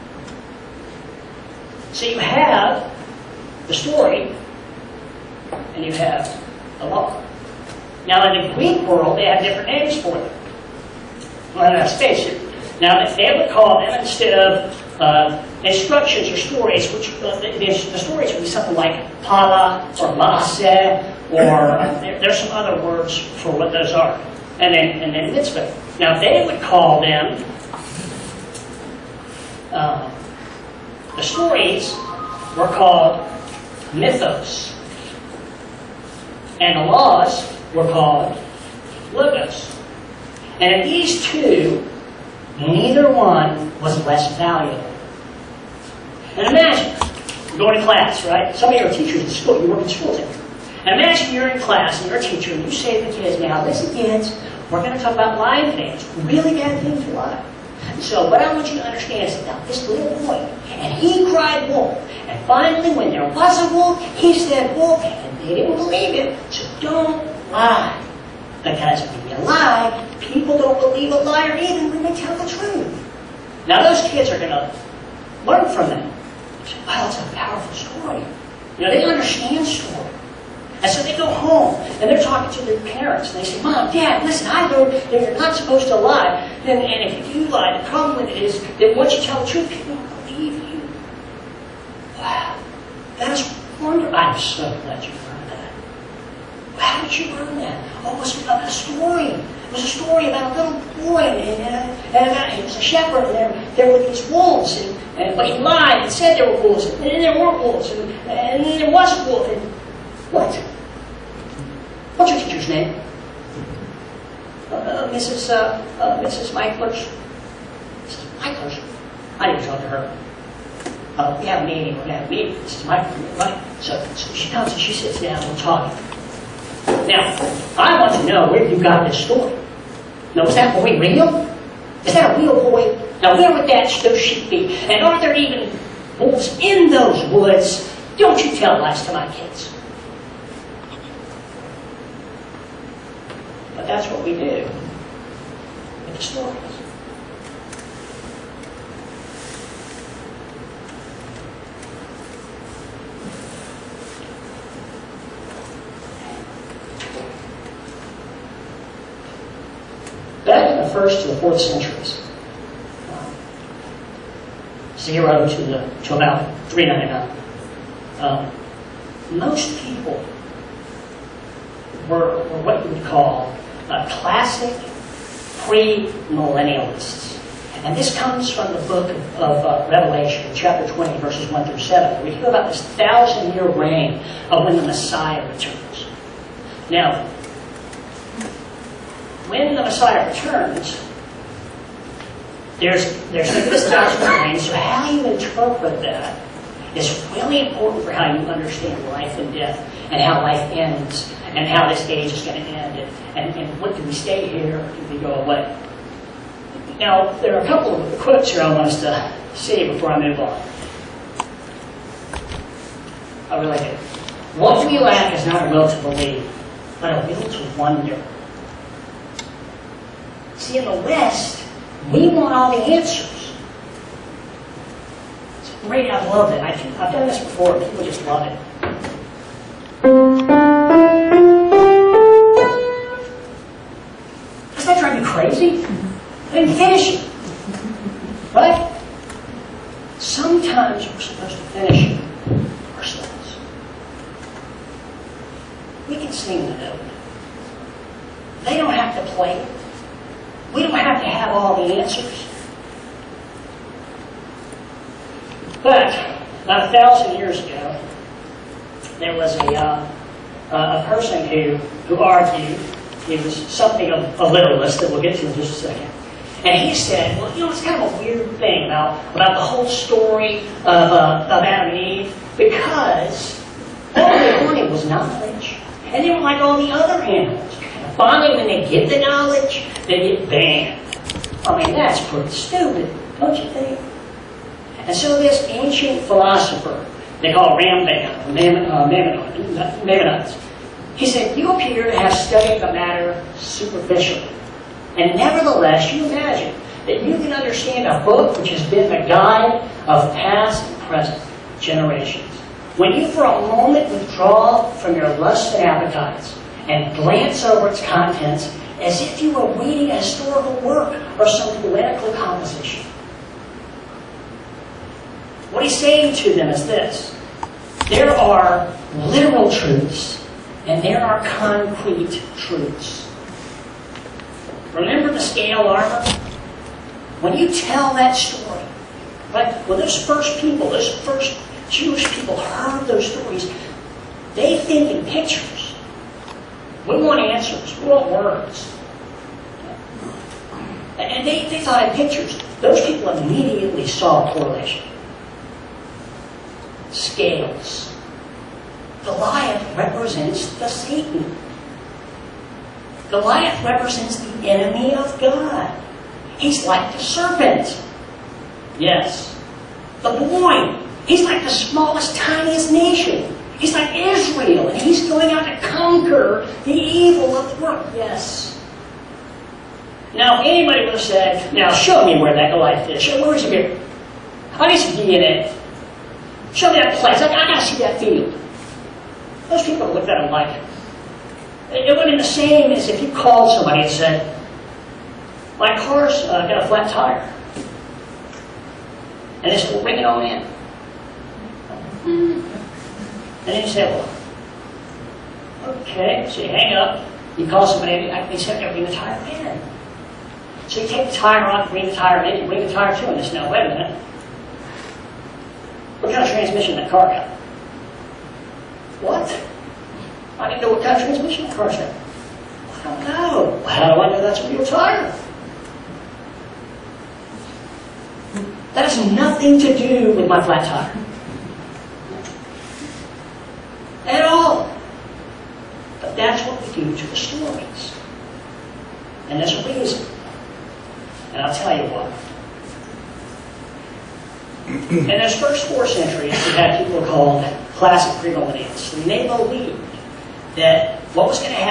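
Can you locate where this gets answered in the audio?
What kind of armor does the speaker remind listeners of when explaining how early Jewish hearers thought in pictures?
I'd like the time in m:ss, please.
5:25.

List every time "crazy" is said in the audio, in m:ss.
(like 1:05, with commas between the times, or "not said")
3:55.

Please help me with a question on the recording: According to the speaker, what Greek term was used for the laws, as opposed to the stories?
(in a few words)
logos.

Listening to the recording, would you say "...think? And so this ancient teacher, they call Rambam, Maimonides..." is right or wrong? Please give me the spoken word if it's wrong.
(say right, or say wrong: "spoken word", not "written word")
wrong: "philosopher", not "teacher".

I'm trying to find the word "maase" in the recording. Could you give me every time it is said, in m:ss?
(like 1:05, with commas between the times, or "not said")
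0:20.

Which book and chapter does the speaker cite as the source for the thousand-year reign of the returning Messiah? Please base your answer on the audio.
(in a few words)
Revelation chapter 20.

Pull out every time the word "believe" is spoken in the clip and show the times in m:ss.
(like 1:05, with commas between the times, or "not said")
1:05, 1:10, 3:36.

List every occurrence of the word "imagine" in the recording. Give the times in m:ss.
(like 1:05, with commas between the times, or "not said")
0:46, 0:50, 4:56.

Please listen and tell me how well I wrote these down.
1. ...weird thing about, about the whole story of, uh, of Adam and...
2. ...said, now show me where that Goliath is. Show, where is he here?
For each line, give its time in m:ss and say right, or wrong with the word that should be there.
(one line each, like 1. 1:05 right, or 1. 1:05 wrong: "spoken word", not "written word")
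1. 4:28 right
2. 6:11 right.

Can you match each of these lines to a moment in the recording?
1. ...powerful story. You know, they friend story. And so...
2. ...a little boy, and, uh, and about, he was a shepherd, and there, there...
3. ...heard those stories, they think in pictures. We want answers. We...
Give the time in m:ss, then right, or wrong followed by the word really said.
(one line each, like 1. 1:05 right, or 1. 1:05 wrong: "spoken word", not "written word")
1. 1:17 wrong: "understand", not "friend"
2. 1:40 right
3. 5:32 right.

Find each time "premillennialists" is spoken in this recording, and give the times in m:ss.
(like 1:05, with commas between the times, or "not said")
2:55, 7:18.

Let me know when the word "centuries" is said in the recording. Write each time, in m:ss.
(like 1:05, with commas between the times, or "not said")
2:41, 7:16.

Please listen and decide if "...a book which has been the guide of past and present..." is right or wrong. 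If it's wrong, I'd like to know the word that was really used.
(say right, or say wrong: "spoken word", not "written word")
right.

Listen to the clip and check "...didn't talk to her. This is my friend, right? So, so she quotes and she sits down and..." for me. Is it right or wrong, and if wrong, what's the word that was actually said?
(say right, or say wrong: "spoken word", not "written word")
wrong: "comes", not "quotes".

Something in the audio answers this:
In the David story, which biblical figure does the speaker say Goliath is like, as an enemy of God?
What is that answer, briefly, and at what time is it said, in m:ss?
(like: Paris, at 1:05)
the serpent, at 5:57.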